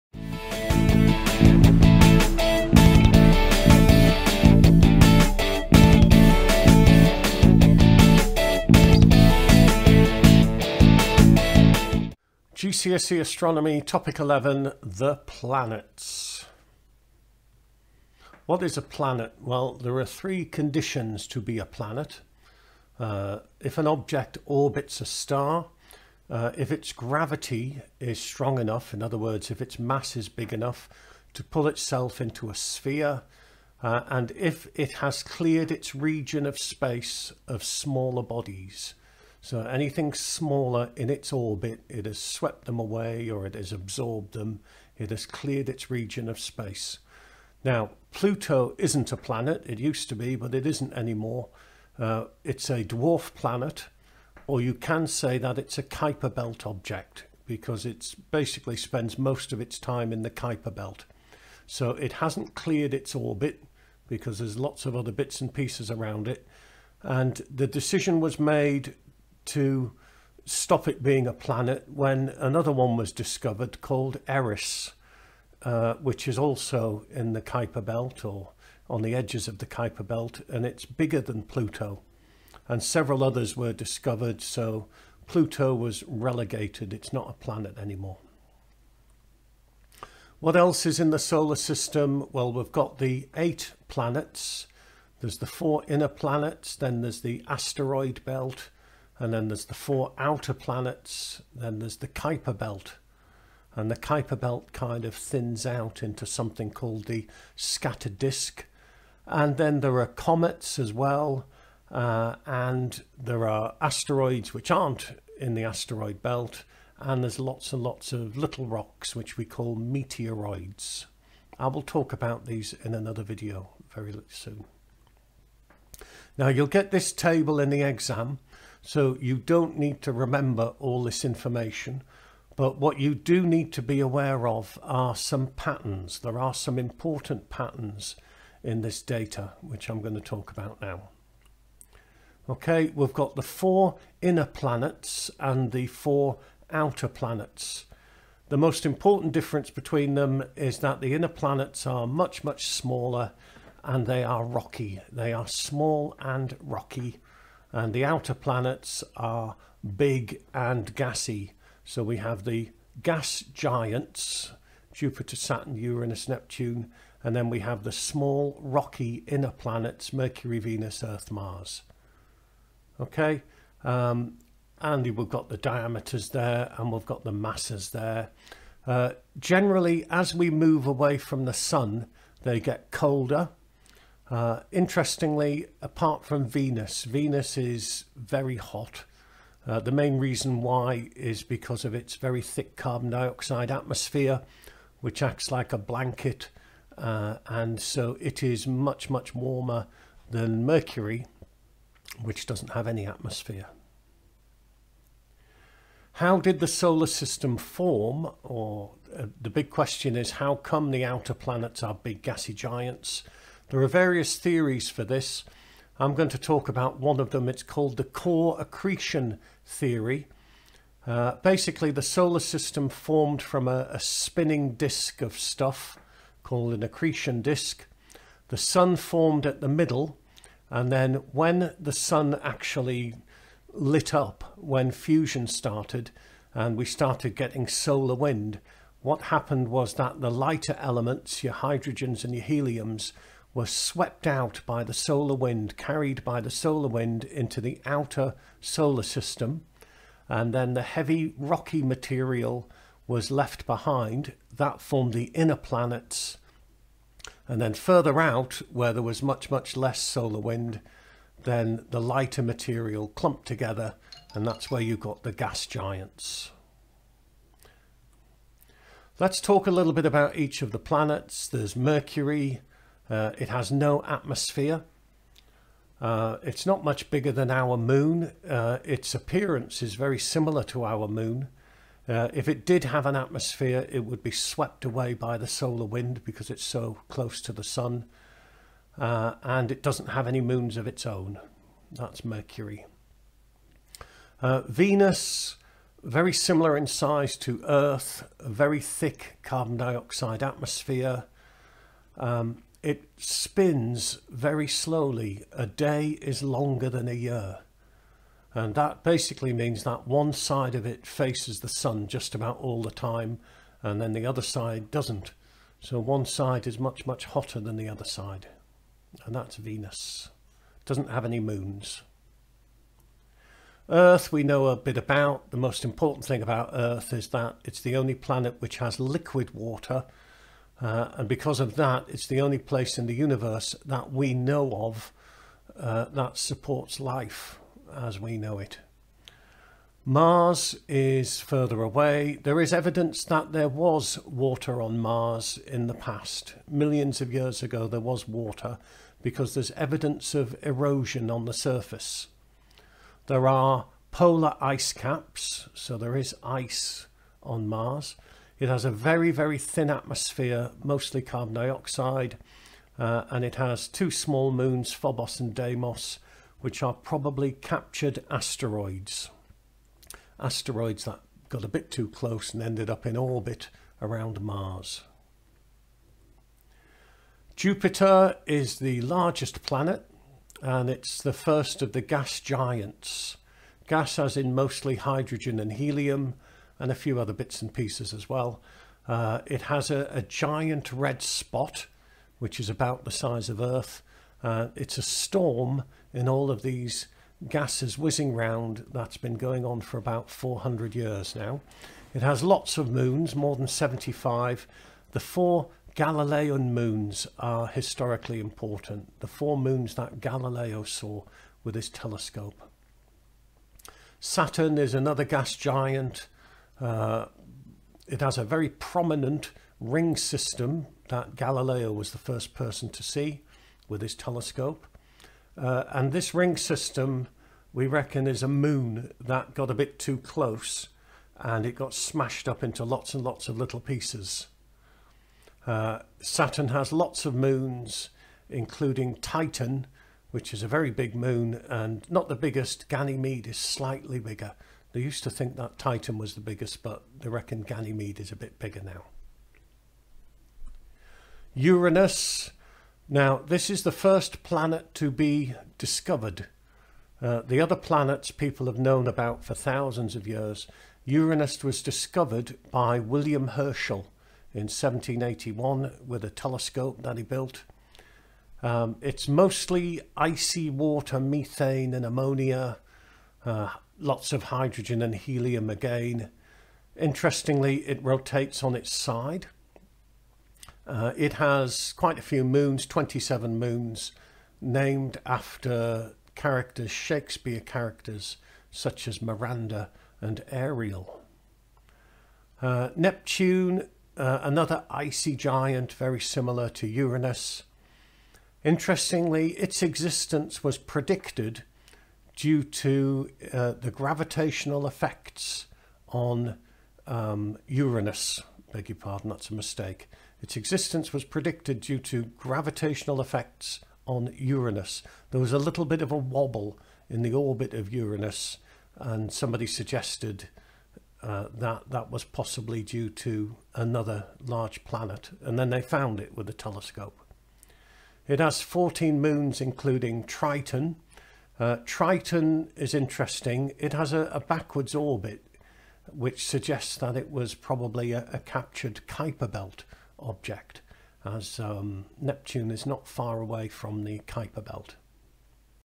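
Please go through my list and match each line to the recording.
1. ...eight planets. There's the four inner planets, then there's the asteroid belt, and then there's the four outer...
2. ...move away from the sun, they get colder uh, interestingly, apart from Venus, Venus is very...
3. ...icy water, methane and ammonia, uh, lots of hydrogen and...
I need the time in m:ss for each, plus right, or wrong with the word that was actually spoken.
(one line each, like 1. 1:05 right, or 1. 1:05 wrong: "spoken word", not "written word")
1. 1:33 right
2. 3:00 right
3. 7:50 right.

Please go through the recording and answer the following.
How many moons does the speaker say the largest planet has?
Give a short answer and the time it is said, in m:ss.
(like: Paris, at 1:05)
more than 75, at 6:43.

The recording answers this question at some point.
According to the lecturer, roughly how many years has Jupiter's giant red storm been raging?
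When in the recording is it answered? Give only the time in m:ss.
6:40.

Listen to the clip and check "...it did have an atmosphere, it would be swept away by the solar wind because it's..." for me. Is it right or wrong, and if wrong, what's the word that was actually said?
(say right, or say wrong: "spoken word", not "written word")
right.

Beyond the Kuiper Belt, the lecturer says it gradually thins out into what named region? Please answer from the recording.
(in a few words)
scattered disk.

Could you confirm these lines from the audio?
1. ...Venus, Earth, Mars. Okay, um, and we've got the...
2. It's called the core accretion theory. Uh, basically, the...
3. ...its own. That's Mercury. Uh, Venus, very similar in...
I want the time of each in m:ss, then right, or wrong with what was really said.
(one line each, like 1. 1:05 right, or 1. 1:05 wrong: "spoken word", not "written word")
1. 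2:50 right
2. 3:37 right
3. 4:50 right.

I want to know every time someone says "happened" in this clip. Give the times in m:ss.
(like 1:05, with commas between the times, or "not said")
3:59.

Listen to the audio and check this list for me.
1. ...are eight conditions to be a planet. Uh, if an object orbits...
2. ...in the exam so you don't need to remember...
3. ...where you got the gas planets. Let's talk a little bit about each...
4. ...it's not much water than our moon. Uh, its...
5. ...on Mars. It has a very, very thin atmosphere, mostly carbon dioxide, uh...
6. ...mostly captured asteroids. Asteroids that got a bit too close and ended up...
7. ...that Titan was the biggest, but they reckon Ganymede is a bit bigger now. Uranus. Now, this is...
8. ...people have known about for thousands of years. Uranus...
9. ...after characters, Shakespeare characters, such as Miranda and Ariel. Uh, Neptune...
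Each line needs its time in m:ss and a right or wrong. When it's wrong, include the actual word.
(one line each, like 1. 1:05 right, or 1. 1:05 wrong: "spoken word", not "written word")
1. 0:19 wrong: "three", not "eight"
2. 2:07 right
3. 4:24 wrong: "giants", not "planets"
4. 4:36 wrong: "bigger", not "water"
5. 5:57 right
6. 6:06 wrong: "probably", not "mostly"
7. 7:25 right
8. 7:38 right
9. 8:05 right.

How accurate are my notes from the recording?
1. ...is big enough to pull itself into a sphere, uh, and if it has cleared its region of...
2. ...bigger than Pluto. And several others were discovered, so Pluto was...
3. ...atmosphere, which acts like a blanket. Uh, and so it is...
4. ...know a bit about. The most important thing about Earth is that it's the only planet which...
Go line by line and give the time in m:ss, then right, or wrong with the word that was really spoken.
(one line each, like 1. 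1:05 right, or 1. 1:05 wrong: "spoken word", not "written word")
1. 0:30 right
2. 1:20 right
3. 3:13 right
4. 5:24 right.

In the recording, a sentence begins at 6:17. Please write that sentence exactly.
Jupiter is the largest planet and it's the first of the gas giants.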